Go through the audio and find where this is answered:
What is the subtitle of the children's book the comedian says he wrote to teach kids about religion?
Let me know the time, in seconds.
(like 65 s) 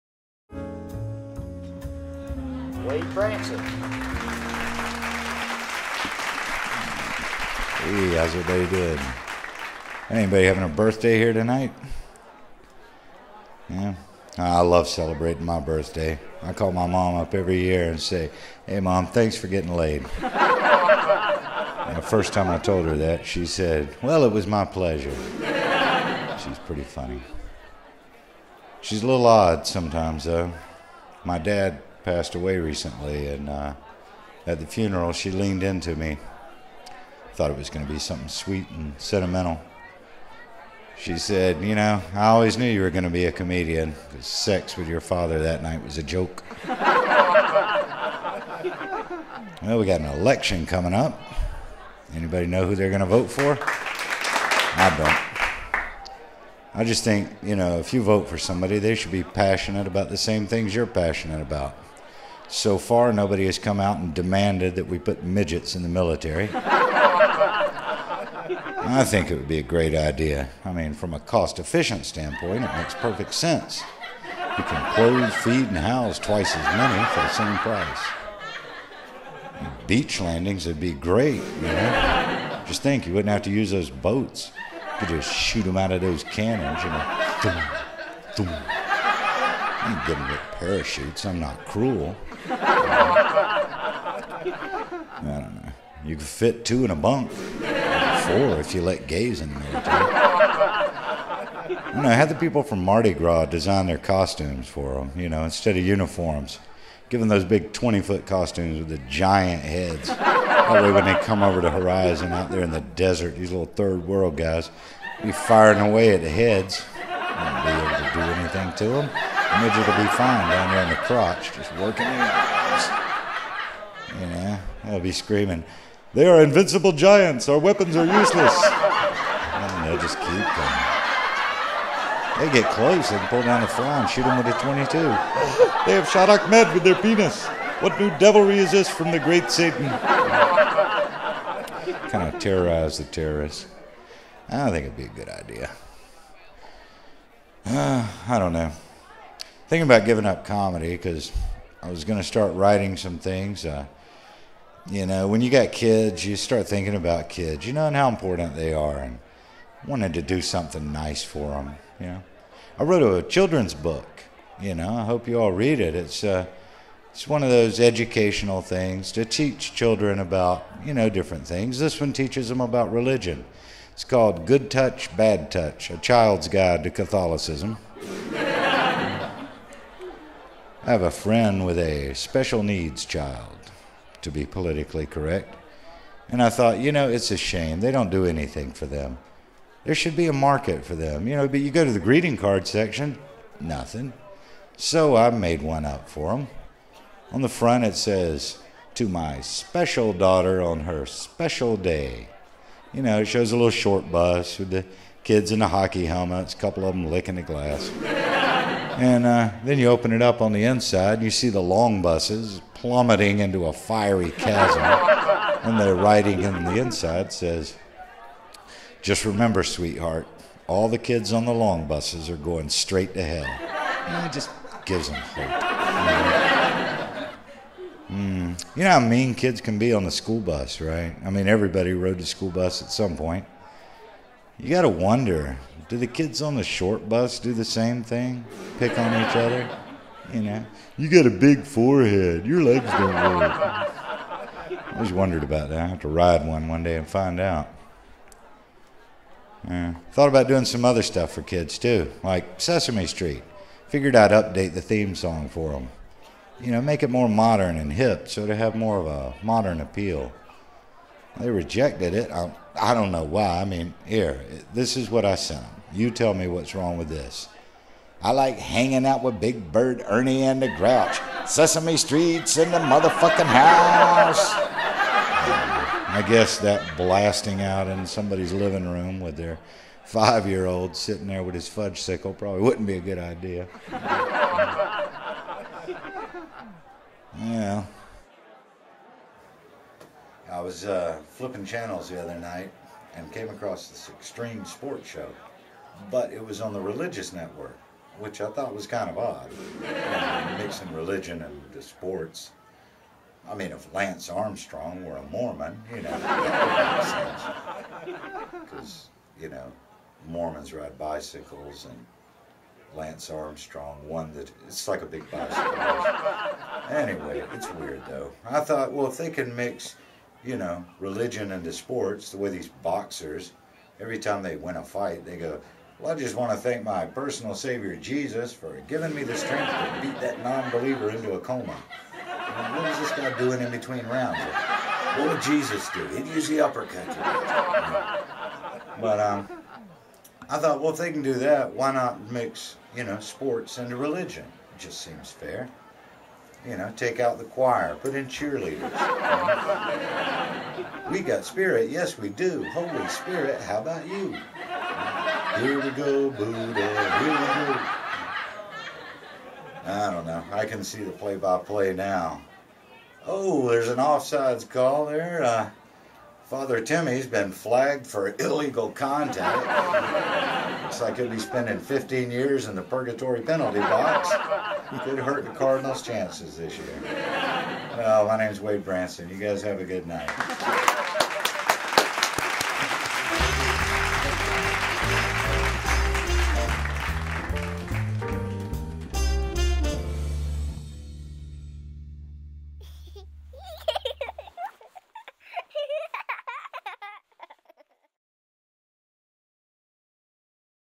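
175 s.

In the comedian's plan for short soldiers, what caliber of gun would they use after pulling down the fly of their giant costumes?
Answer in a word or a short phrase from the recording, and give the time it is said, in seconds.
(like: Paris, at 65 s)
22, at 134 s.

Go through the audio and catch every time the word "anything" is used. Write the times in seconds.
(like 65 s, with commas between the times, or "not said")
118 s, 188 s.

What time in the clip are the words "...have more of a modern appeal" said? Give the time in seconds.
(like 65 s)
258 s.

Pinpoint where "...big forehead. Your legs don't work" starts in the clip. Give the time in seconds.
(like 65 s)
241 s.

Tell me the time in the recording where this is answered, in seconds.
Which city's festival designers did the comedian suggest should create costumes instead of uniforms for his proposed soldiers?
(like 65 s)
102 s.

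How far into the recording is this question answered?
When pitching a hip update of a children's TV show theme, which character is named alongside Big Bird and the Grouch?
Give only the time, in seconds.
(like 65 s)
270 s.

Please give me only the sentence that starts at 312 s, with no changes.
Lance Armstrong won that it's like a big bicycle.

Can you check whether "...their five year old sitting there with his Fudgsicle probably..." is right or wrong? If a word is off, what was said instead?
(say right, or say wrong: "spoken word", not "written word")
right.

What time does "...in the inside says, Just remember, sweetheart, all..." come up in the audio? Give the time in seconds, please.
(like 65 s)
216 s.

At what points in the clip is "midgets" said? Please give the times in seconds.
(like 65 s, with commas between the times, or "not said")
65 s, 119 s.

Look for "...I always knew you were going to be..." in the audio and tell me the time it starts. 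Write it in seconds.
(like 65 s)
42 s.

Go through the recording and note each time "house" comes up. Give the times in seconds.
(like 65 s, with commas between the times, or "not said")
75 s, 273 s.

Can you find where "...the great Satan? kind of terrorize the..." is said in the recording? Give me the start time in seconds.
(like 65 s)
139 s.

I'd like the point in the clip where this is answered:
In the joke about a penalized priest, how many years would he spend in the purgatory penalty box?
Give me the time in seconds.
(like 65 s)
371 s.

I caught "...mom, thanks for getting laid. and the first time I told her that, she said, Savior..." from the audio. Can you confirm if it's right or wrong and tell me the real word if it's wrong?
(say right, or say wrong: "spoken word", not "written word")
wrong: "Well", not "Savior".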